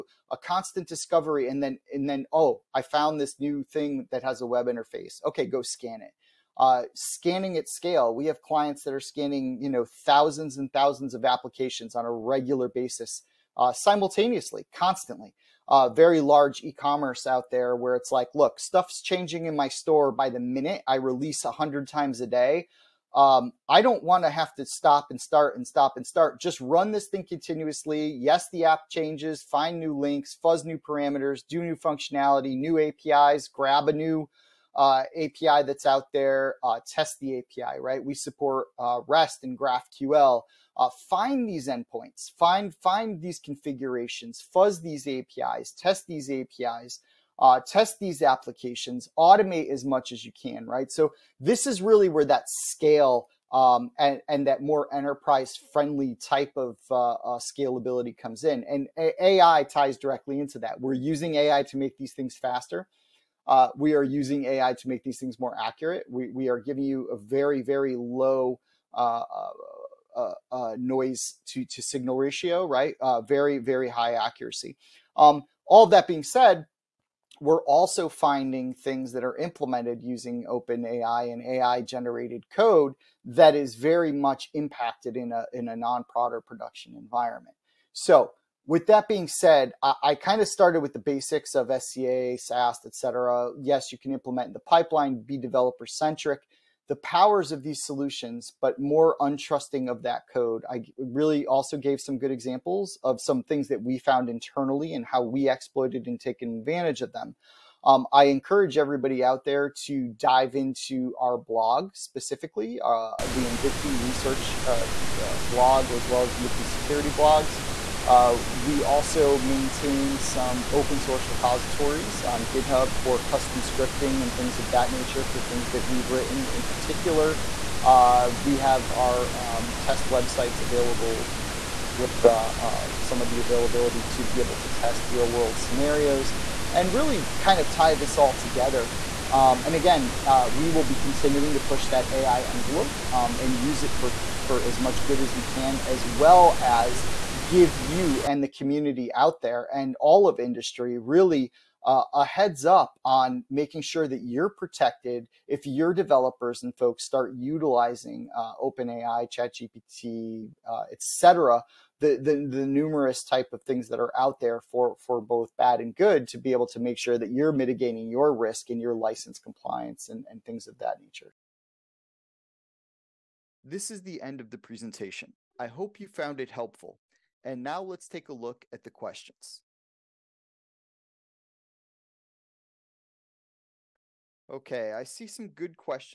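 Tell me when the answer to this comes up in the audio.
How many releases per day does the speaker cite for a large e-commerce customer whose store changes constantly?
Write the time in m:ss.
0:21.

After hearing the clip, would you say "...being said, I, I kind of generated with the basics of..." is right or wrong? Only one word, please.
wrong.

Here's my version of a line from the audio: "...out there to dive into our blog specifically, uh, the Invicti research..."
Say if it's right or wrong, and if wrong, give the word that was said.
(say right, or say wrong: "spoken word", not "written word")
right.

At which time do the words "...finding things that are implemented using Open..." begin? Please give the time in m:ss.
1:18.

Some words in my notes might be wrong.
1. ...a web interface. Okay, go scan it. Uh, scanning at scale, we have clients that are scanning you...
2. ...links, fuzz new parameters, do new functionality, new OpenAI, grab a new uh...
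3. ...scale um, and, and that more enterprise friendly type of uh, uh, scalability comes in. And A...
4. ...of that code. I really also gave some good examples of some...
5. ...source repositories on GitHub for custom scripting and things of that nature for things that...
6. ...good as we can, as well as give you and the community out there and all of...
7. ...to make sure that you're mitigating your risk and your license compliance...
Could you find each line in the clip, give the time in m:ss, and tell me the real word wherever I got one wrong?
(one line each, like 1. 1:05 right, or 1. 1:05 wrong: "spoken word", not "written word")
1. 0:04 right
2. 0:29 wrong: "APIs", not "OpenAI"
3. 0:52 right
4. 1:39 right
5. 2:00 right
6. 2:25 right
7. 2:46 right.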